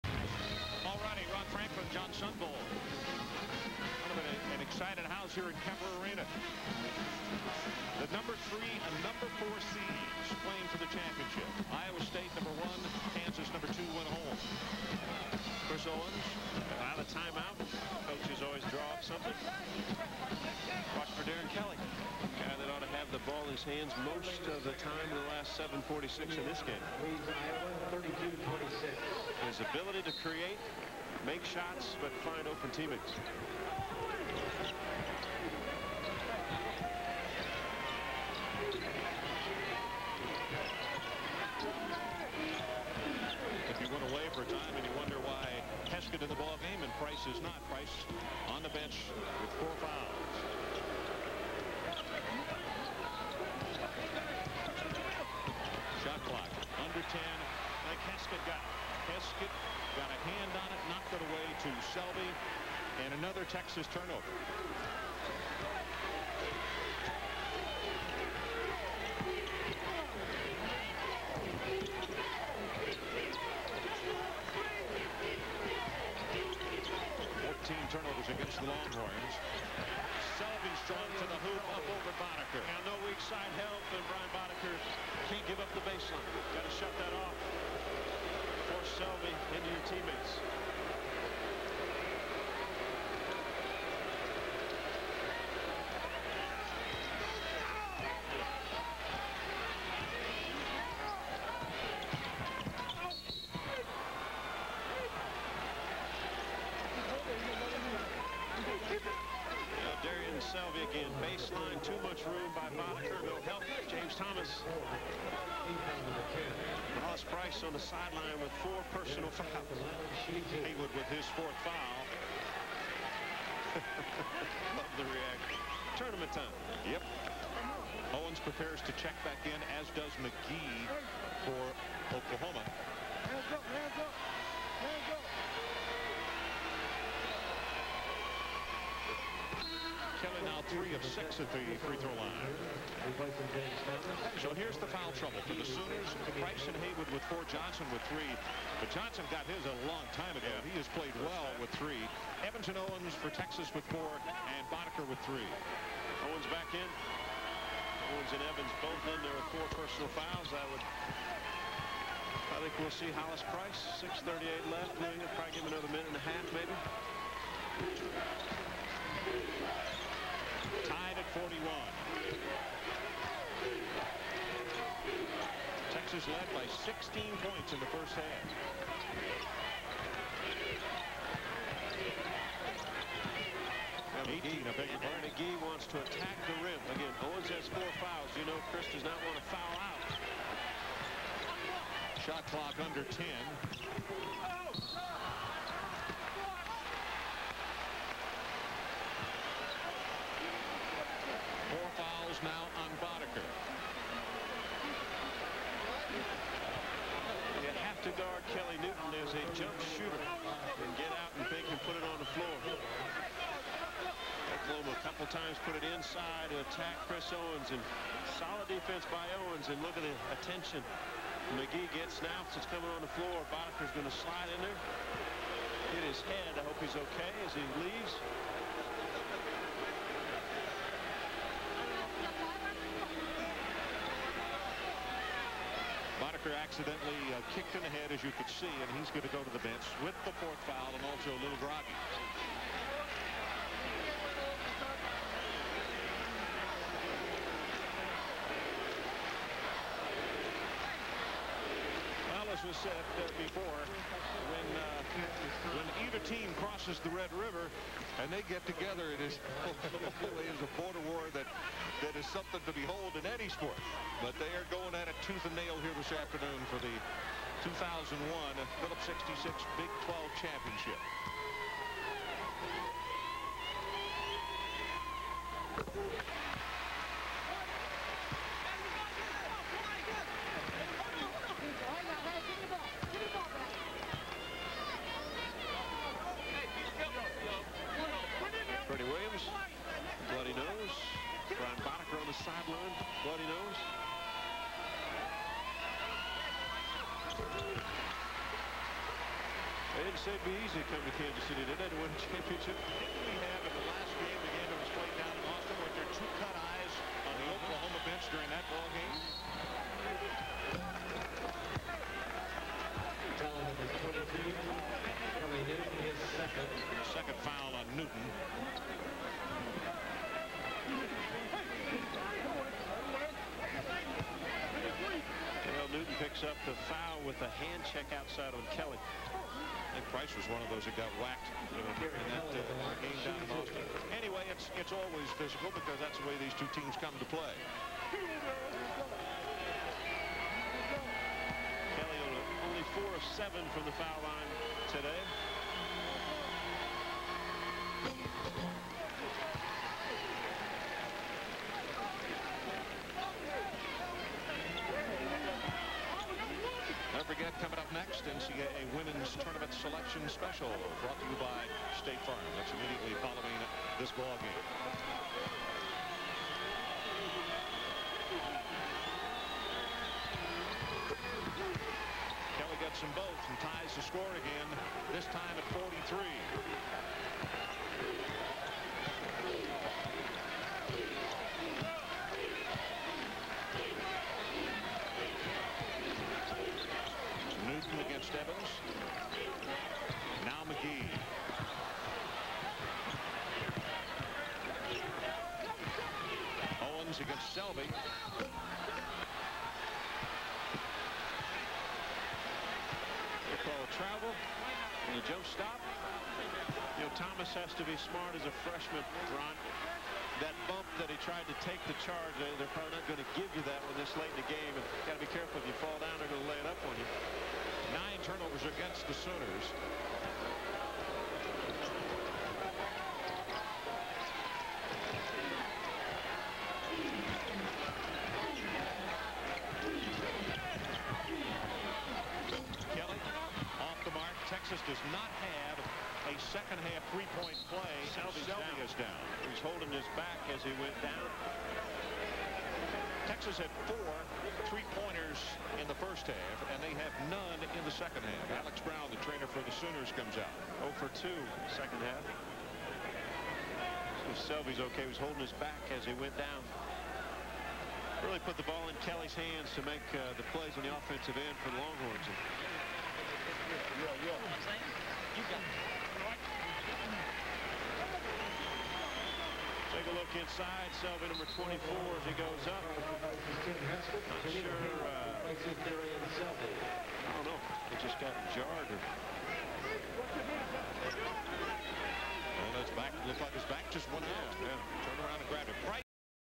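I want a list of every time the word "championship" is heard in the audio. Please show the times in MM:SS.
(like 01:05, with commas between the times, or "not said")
00:10, 04:30, 05:02.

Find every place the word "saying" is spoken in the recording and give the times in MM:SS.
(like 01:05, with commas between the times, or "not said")
07:44.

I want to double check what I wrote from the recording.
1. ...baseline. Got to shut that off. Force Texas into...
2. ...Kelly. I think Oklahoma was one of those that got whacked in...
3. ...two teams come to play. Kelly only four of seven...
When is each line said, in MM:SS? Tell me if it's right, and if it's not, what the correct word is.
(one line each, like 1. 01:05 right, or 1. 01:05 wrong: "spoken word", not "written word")
1. 01:25 wrong: "Selvy", not "Texas"
2. 05:28 wrong: "Price", not "Oklahoma"
3. 05:36 right.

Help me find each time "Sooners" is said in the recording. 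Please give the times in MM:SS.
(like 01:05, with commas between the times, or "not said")
02:25, 06:59, 07:29.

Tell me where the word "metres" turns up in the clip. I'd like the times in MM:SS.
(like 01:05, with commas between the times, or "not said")
not said.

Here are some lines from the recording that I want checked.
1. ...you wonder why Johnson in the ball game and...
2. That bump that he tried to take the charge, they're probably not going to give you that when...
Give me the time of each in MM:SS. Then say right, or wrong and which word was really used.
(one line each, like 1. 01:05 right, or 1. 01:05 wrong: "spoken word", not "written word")
1. 00:44 wrong: "Heskett", not "Johnson"
2. 06:50 right.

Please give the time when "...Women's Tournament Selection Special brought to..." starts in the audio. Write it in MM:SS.
05:58.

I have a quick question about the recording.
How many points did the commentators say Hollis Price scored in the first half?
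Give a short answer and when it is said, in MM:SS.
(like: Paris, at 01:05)
16, at 02:56.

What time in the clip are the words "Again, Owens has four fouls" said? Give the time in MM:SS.
03:06.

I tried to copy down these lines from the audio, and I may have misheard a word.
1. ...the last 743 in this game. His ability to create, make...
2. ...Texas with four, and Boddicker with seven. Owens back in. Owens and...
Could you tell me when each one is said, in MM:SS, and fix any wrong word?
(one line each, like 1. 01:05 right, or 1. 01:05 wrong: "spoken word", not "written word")
1. 00:25 wrong: "746", not "743"
2. 02:33 wrong: "three", not "seven".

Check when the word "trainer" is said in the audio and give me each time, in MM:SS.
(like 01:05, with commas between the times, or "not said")
07:29.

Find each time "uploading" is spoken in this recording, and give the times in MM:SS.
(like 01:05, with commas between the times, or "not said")
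not said.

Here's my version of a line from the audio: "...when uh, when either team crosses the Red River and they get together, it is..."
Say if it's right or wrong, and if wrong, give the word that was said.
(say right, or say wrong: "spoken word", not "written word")
right.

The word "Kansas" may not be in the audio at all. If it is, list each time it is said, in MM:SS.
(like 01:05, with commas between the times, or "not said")
00:13, 05:01.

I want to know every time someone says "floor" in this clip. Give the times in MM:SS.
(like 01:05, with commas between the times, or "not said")
03:32, 03:43.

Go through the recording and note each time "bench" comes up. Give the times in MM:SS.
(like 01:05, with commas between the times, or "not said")
00:48, 03:59.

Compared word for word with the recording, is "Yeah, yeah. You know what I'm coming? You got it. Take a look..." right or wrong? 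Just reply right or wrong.
wrong.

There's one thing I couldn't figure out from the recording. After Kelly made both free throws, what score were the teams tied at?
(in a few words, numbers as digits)
43.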